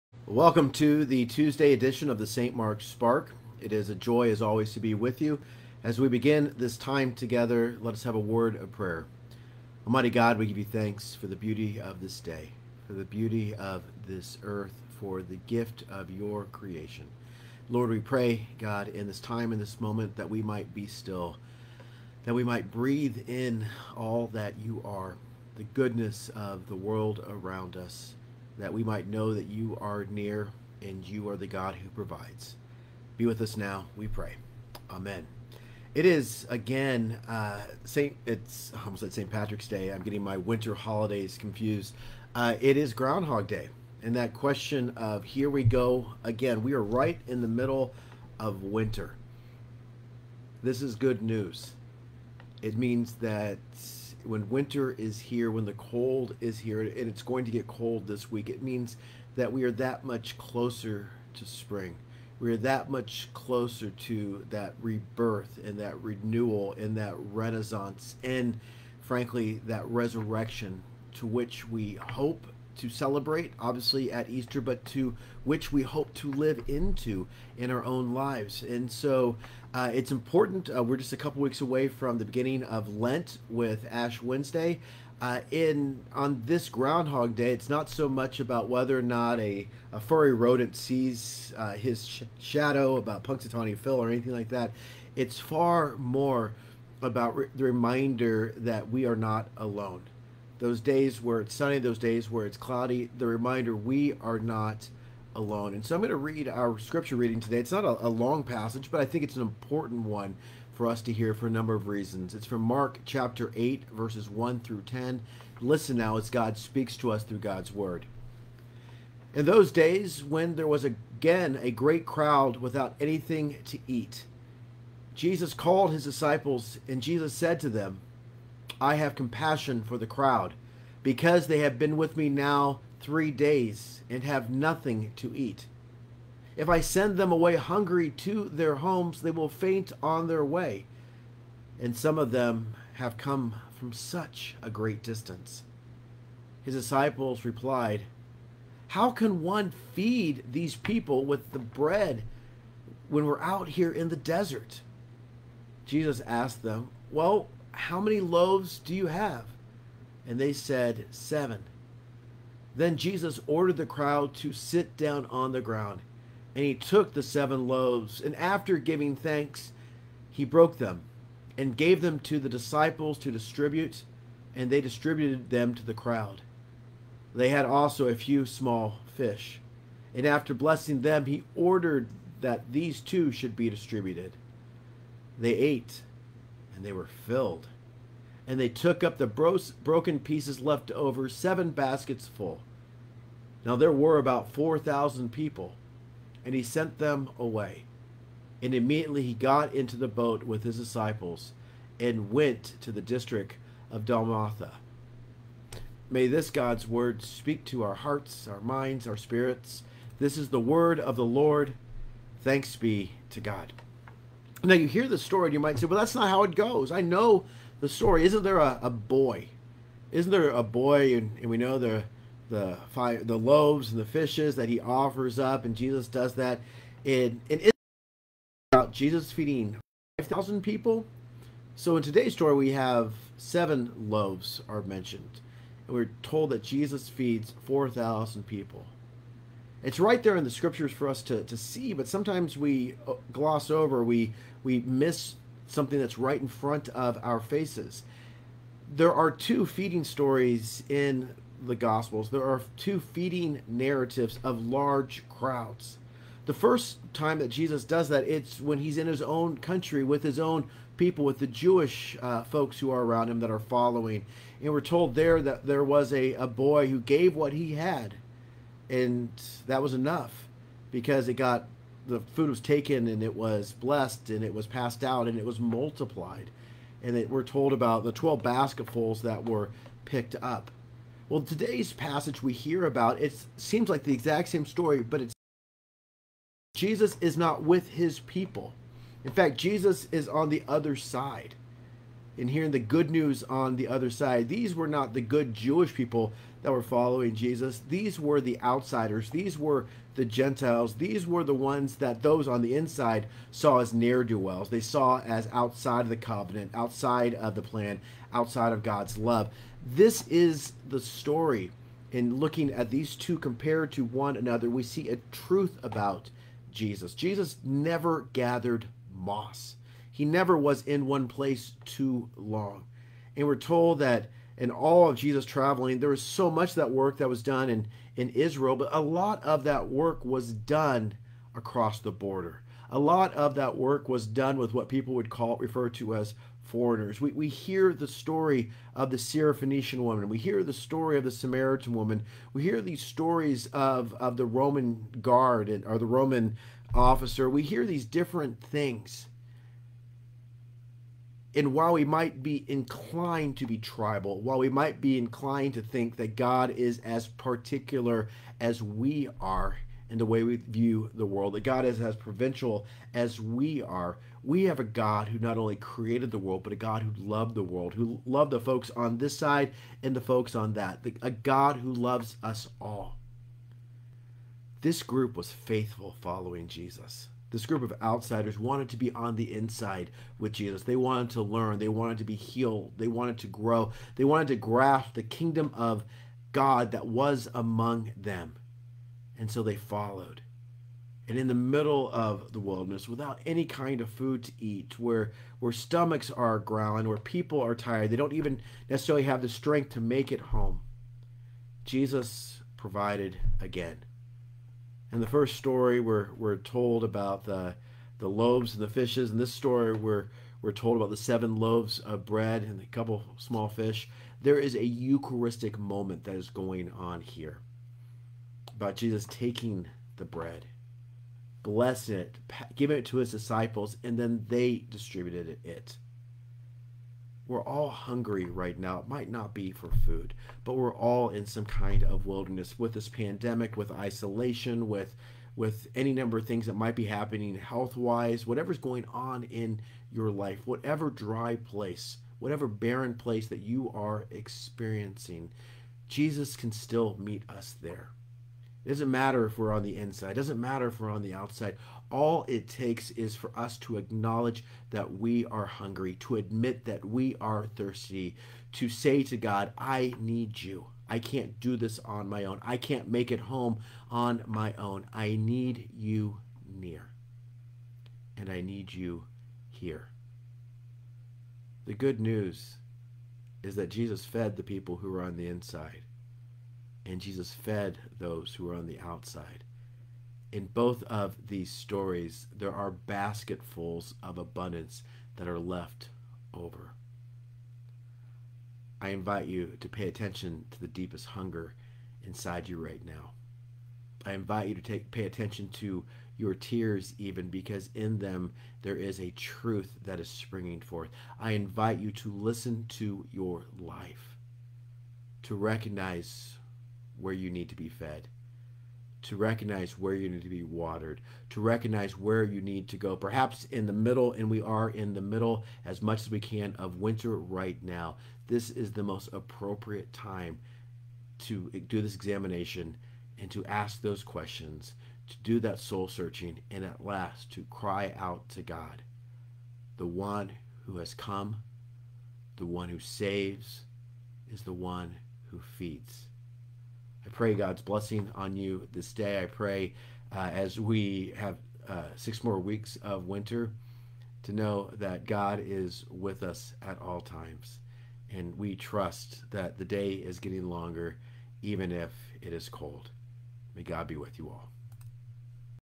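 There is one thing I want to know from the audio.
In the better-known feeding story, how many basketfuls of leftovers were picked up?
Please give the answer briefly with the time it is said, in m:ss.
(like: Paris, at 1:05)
12, at 4:38.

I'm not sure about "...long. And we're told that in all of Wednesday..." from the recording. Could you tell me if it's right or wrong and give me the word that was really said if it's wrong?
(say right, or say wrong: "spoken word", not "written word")
wrong: "Jesus", not "Wednesday".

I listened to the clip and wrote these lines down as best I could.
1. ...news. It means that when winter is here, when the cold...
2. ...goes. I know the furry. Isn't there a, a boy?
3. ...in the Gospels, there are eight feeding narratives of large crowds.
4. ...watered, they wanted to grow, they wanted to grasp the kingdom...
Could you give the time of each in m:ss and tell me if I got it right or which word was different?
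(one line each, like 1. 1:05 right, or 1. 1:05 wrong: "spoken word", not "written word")
1. 0:51 right
2. 3:36 wrong: "story", not "furry"
3. 4:10 wrong: "two", not "eight"
4. 6:22 wrong: "healed", not "watered".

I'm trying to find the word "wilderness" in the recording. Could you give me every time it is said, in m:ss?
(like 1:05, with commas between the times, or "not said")
6:32, 7:12.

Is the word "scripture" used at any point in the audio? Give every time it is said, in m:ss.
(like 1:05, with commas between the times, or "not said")
1:46, 4:00.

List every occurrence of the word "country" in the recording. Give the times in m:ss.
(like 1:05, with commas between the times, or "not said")
4:19.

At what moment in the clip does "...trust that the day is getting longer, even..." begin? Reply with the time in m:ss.
9:08.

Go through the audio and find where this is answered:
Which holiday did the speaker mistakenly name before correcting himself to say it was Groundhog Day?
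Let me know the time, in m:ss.
0:39.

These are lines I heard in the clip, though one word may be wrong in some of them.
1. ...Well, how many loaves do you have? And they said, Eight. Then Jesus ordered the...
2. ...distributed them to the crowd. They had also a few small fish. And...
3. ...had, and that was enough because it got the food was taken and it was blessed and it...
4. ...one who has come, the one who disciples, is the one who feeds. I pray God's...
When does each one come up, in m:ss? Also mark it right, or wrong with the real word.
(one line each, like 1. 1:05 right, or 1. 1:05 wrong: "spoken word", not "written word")
1. 2:37 wrong: "Seven", not "Eight"
2. 2:54 right
3. 4:27 right
4. 8:50 wrong: "saves", not "disciples".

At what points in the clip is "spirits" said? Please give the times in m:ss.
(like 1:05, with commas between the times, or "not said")
3:29.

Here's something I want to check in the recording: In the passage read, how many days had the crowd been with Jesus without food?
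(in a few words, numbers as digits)
3.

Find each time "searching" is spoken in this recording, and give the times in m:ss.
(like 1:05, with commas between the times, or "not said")
8:46.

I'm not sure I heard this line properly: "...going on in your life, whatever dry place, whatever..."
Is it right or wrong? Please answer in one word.
right.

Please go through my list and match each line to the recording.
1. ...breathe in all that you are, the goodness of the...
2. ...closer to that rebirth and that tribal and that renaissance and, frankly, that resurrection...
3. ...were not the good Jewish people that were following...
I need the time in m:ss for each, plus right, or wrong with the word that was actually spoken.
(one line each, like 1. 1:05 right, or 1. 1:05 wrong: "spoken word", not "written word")
1. 0:22 right
2. 1:03 wrong: "renewal", not "tribal"
3. 4:54 right.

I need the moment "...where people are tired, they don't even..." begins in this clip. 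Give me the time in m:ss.
6:37.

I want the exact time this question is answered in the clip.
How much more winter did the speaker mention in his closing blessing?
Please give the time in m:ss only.
9:02.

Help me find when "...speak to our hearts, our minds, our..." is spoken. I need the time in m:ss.
3:27.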